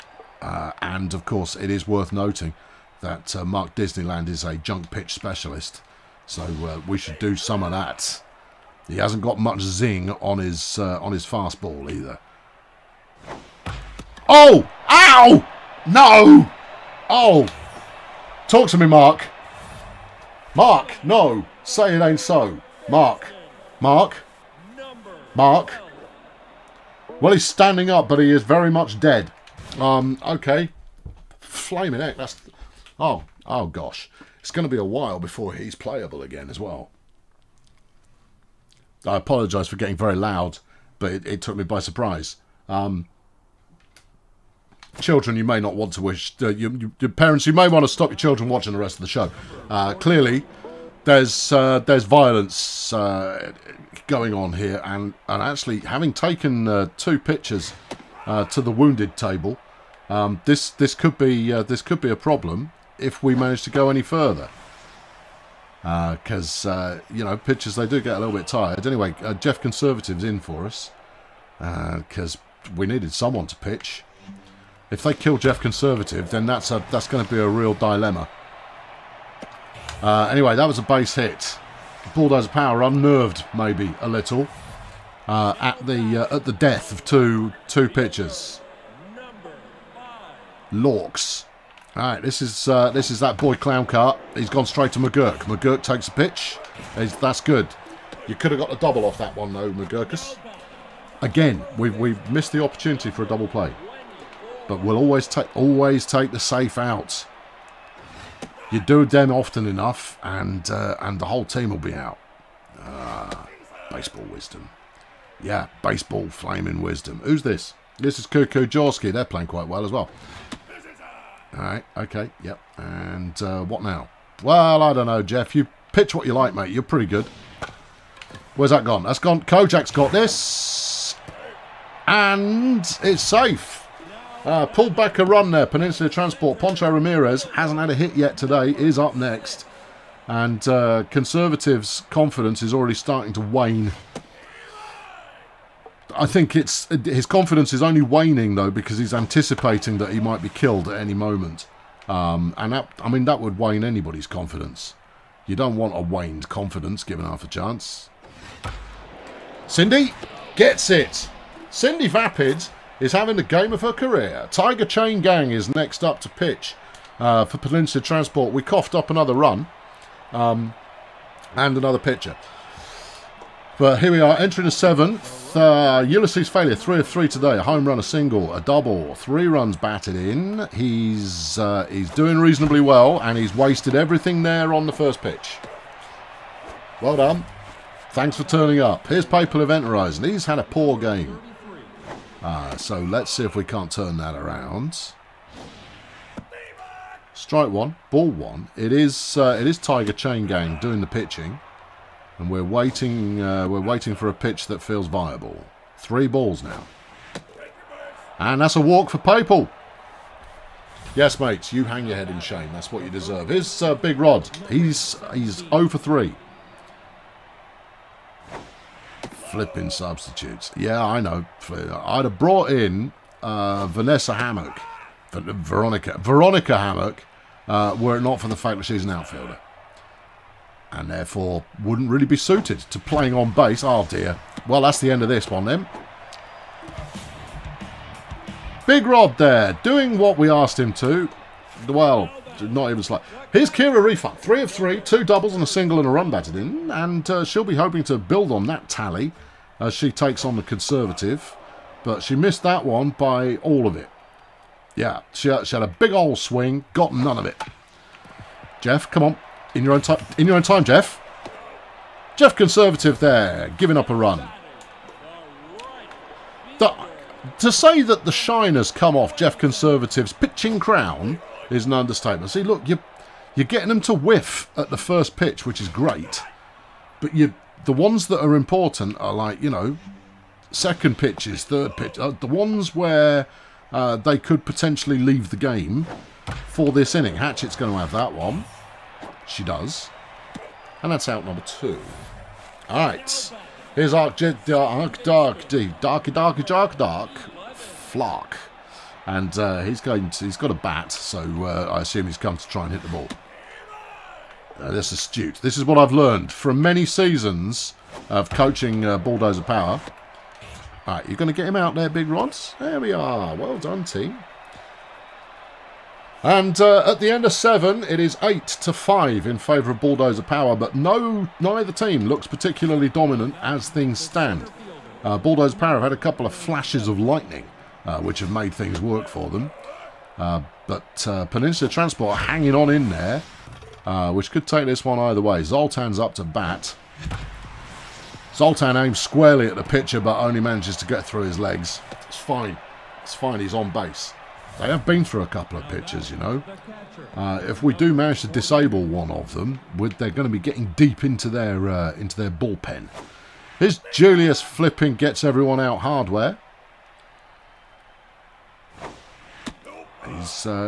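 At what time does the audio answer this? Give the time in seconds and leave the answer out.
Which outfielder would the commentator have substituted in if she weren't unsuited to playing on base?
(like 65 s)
226 s.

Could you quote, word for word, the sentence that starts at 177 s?
A home run, a single, a double, three runs batted in.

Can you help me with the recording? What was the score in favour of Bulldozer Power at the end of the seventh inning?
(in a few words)
8 to 5.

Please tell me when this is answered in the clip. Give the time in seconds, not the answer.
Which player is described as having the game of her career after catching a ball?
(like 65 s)
161 s.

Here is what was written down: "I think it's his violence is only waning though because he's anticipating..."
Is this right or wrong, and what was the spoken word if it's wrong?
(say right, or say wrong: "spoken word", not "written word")
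wrong: "confidence", not "violence".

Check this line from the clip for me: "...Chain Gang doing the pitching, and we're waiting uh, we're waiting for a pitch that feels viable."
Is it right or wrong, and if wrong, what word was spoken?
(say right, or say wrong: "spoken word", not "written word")
right.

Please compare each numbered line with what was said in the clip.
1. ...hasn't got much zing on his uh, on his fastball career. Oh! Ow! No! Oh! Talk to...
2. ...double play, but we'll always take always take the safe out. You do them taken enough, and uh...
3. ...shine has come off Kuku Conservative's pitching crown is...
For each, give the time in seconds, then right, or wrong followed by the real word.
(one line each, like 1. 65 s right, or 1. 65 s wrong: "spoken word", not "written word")
1. 8 s wrong: "either", not "career"
2. 103 s wrong: "often", not "taken"
3. 268 s wrong: "Jeff", not "Kuku".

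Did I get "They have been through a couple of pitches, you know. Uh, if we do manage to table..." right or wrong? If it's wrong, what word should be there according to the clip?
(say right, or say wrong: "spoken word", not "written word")
wrong: "disable", not "table".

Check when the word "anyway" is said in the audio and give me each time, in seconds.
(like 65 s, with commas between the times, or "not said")
68 s, 80 s.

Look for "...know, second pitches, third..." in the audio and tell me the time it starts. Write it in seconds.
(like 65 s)
279 s.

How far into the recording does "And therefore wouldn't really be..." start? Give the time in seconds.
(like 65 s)
230 s.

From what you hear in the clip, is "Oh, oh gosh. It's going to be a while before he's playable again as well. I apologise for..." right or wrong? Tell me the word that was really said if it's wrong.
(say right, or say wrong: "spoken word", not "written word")
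right.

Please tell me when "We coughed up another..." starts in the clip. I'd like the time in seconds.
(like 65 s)
168 s.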